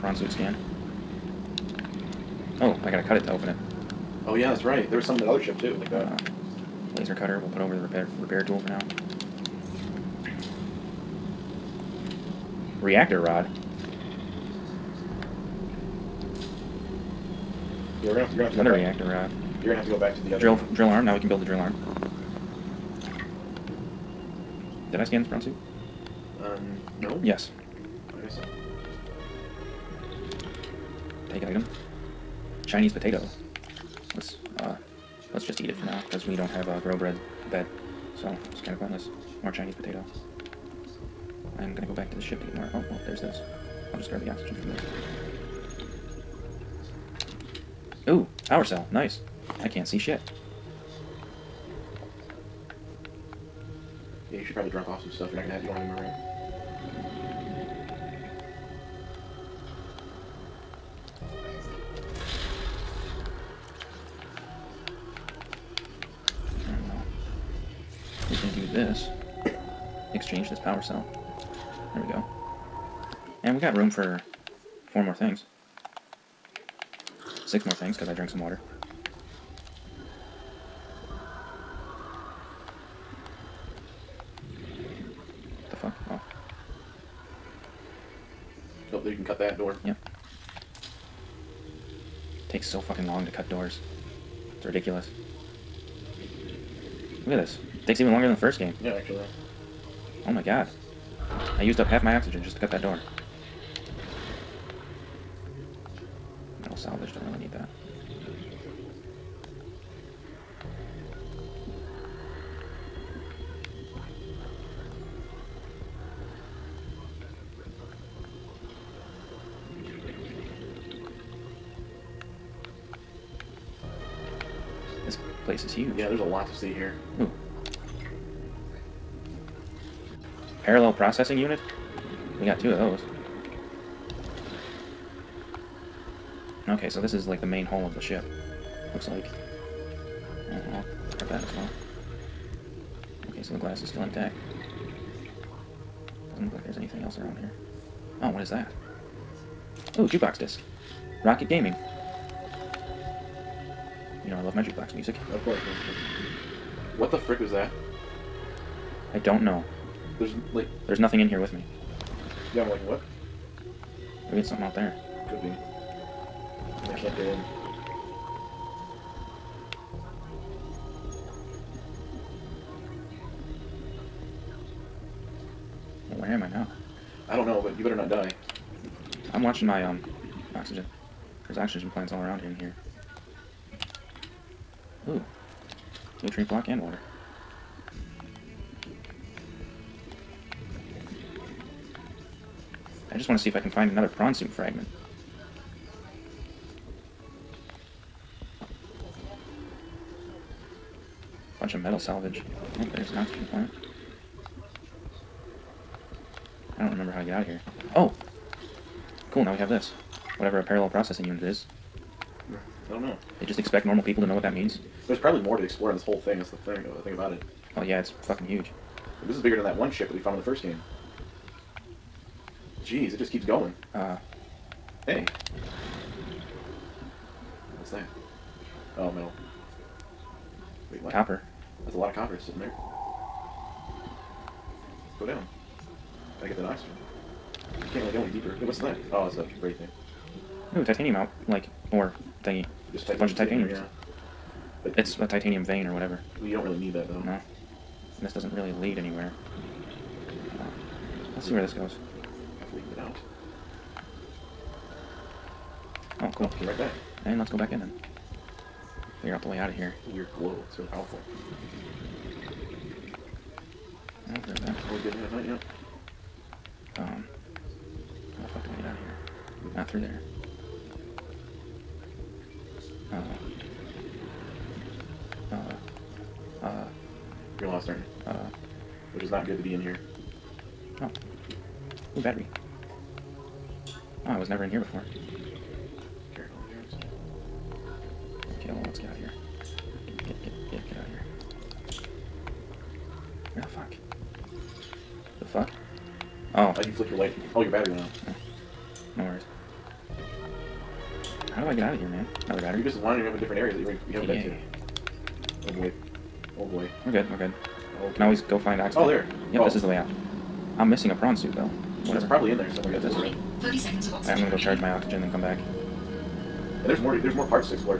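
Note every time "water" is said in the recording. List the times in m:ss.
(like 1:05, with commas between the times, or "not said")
1:18, 3:06.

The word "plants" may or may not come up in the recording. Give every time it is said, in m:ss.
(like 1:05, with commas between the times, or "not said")
3:01, 3:23.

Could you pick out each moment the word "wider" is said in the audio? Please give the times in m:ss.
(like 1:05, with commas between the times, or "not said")
not said.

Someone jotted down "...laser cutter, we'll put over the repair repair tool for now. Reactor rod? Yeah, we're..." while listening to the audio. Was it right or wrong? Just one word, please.
right.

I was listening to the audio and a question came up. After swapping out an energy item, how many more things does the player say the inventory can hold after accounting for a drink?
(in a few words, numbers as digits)
6.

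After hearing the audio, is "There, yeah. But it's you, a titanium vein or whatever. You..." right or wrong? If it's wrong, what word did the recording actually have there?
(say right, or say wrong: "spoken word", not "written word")
right.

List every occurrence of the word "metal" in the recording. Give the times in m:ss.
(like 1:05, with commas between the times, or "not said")
3:21, 3:49.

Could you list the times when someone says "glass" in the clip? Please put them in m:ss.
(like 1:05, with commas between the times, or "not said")
2:23.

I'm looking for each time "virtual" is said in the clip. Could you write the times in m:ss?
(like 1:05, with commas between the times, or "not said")
not said.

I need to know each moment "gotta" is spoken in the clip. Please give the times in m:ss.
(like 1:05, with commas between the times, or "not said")
0:02, 3:56.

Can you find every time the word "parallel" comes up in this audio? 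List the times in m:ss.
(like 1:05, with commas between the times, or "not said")
2:10, 3:30.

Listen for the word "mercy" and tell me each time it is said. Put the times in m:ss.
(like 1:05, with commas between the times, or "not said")
not said.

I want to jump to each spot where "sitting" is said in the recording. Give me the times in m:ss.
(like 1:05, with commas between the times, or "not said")
3:52.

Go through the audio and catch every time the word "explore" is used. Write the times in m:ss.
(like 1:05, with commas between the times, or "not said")
3:35.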